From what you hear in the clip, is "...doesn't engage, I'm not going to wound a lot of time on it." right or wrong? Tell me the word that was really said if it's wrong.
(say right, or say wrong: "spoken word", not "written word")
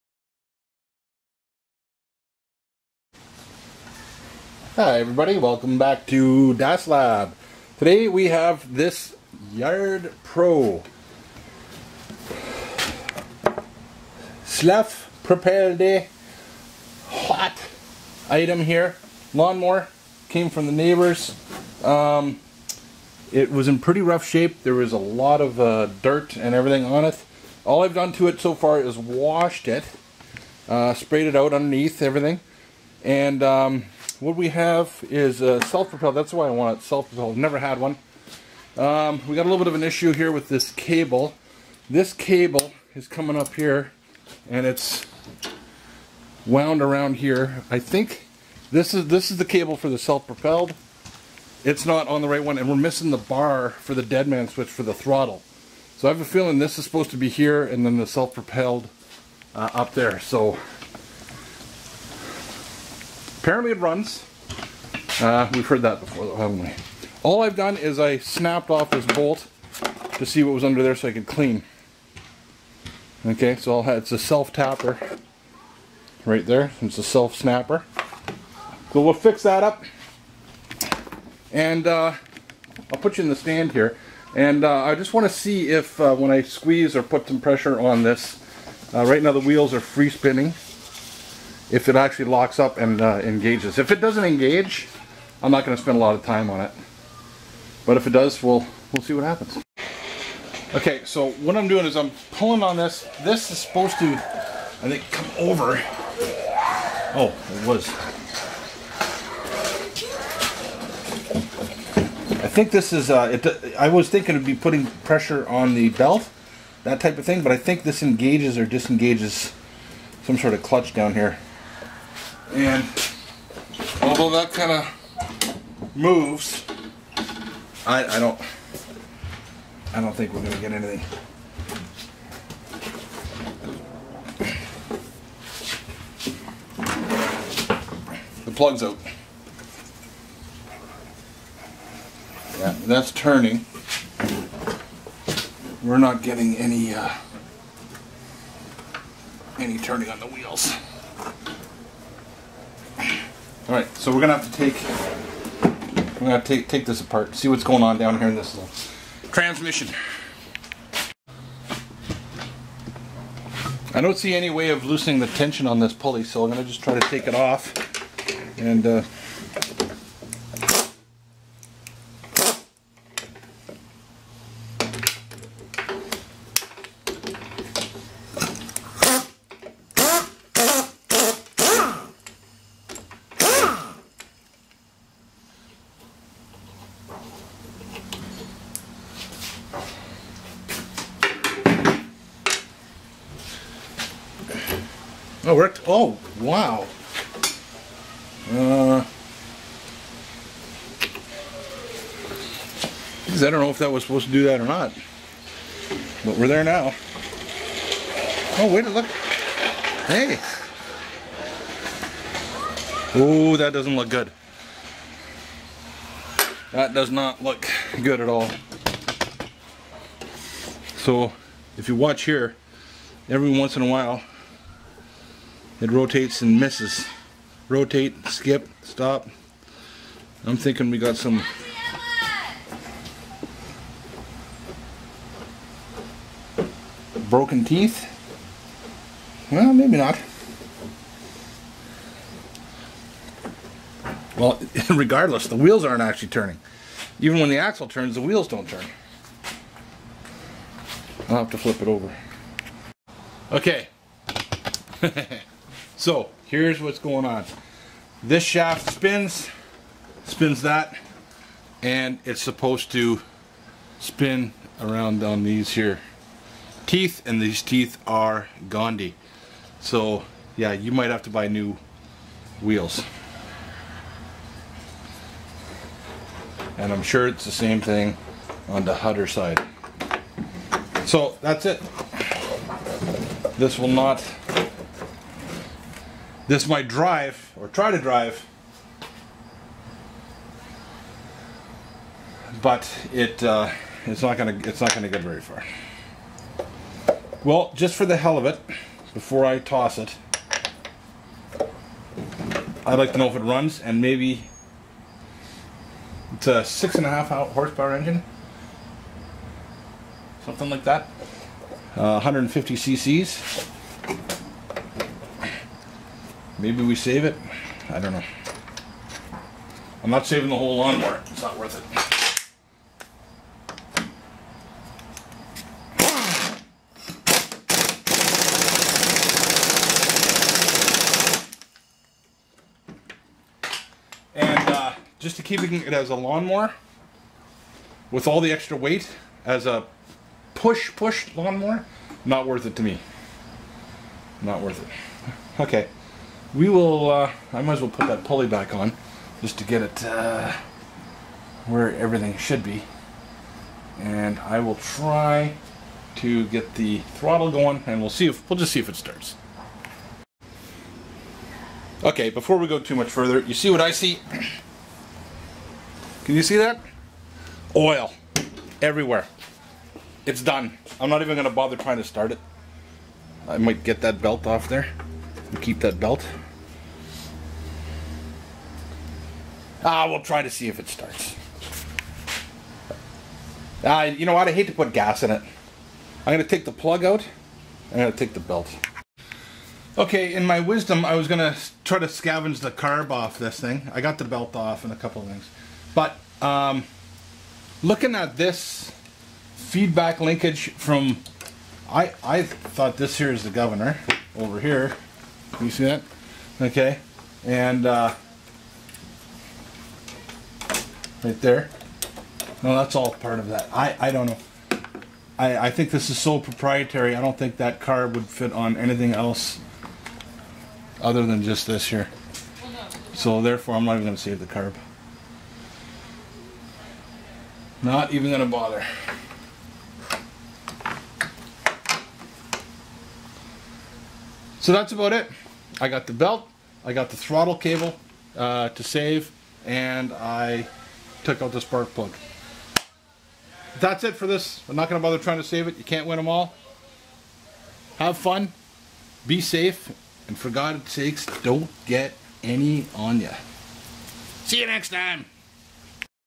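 wrong: "spend", not "wound".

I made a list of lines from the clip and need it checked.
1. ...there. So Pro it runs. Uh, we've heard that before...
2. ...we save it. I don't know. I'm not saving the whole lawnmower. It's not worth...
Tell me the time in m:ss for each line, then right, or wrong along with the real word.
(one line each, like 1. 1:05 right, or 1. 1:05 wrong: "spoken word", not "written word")
1. 0:59 wrong: "Apparently", not "Pro"
2. 5:16 right.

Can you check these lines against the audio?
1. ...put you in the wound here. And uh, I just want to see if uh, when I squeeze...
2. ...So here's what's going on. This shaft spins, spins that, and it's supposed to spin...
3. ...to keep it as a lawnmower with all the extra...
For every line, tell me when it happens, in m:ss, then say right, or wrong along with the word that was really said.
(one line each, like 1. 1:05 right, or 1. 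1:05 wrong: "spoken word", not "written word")
1. 1:23 wrong: "stand", not "wound"
2. 4:16 right
3. 5:35 right.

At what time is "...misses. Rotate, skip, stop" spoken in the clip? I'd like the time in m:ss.
3:46.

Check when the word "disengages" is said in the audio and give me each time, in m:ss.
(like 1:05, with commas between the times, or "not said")
1:58.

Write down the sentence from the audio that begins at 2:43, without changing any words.
I don't see any way of loosening the tension on this pulley, so I'm gonna just try to take it off and.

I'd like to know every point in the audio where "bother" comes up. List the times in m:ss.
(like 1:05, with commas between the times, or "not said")
6:11, 7:08, 7:25.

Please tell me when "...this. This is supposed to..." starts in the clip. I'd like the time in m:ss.
1:42.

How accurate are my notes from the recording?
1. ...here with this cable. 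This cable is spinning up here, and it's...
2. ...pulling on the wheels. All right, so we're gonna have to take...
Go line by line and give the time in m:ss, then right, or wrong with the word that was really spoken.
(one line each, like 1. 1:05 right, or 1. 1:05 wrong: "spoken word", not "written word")
1. 0:40 wrong: "coming", not "spinning"
2. 2:29 wrong: "turning", not "pulling".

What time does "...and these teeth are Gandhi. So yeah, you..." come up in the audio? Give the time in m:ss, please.
4:27.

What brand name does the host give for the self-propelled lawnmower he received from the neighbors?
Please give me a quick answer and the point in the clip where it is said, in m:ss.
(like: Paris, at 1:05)
Yard Pro, at 0:09.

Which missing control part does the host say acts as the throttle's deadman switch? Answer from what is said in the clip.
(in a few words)
the bar.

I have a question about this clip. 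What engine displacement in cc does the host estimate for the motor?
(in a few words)
150 cc.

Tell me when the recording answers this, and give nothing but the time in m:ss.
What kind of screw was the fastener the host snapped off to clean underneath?
1:14.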